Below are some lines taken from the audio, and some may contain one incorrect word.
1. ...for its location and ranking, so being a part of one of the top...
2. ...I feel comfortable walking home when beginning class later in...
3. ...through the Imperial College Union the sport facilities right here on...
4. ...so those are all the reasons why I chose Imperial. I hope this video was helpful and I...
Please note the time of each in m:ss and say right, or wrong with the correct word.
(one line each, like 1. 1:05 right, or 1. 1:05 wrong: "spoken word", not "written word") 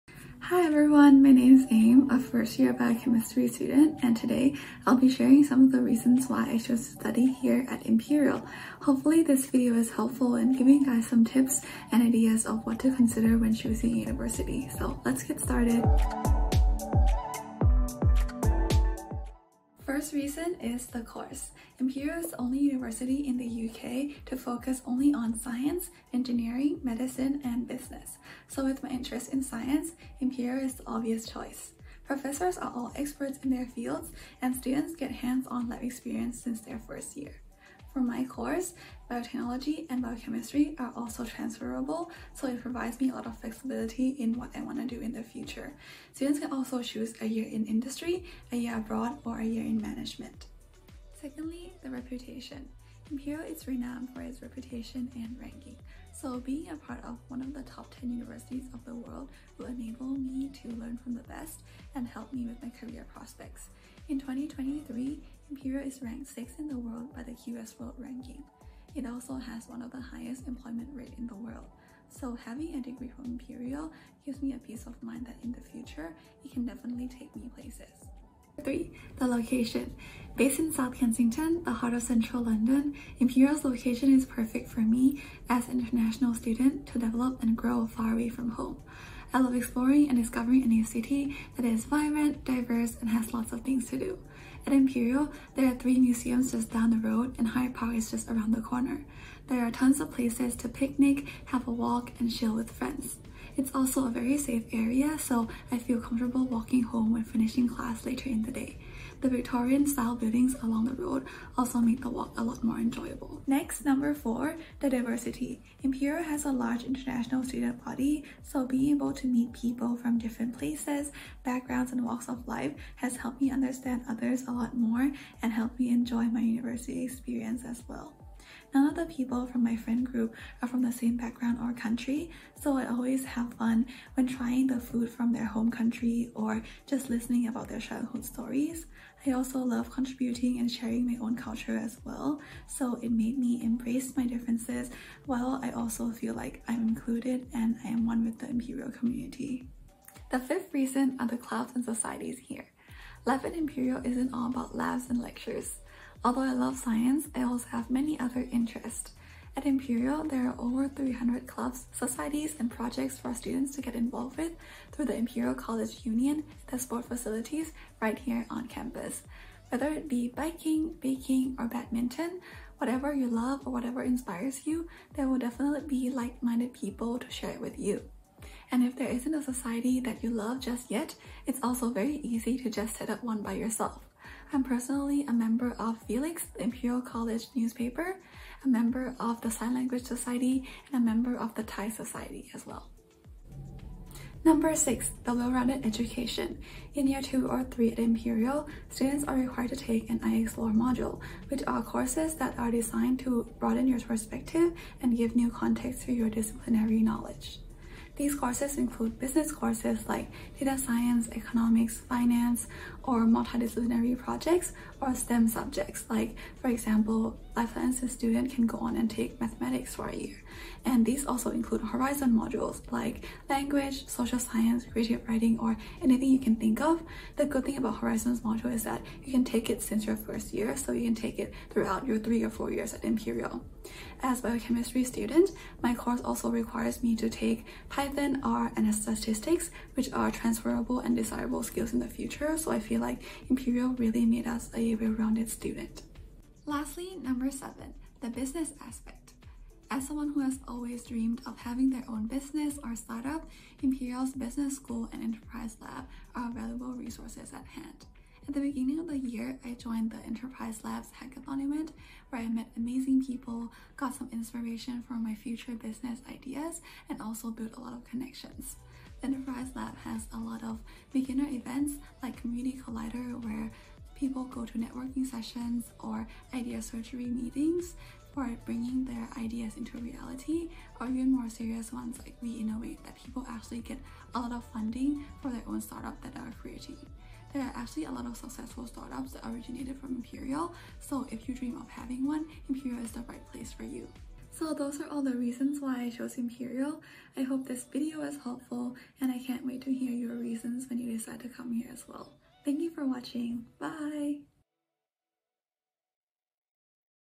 1. 0:54 wrong: "reputation", not "location"
2. 1:45 wrong: "finishing", not "beginning"
3. 2:44 right
4. 4:54 right.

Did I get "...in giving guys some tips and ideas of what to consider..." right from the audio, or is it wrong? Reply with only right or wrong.
right.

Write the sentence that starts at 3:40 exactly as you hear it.
And these also include horizon modules like language, social science, creative writing, or anything you can think of.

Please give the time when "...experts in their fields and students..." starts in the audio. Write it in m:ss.
0:32.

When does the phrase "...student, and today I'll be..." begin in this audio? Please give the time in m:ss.
0:03.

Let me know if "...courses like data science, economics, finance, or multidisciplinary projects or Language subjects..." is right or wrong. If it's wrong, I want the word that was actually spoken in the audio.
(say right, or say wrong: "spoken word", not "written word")
wrong: "STEM", not "Language".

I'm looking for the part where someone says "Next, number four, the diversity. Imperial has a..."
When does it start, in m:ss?
1:53.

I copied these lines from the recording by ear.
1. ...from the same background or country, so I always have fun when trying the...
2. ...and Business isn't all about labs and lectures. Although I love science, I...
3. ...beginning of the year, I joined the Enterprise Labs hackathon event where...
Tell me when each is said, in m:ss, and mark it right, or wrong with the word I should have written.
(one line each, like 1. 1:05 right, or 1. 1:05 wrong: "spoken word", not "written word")
1. 2:10 right
2. 2:33 wrong: "Imperial", not "Business"
3. 4:18 right.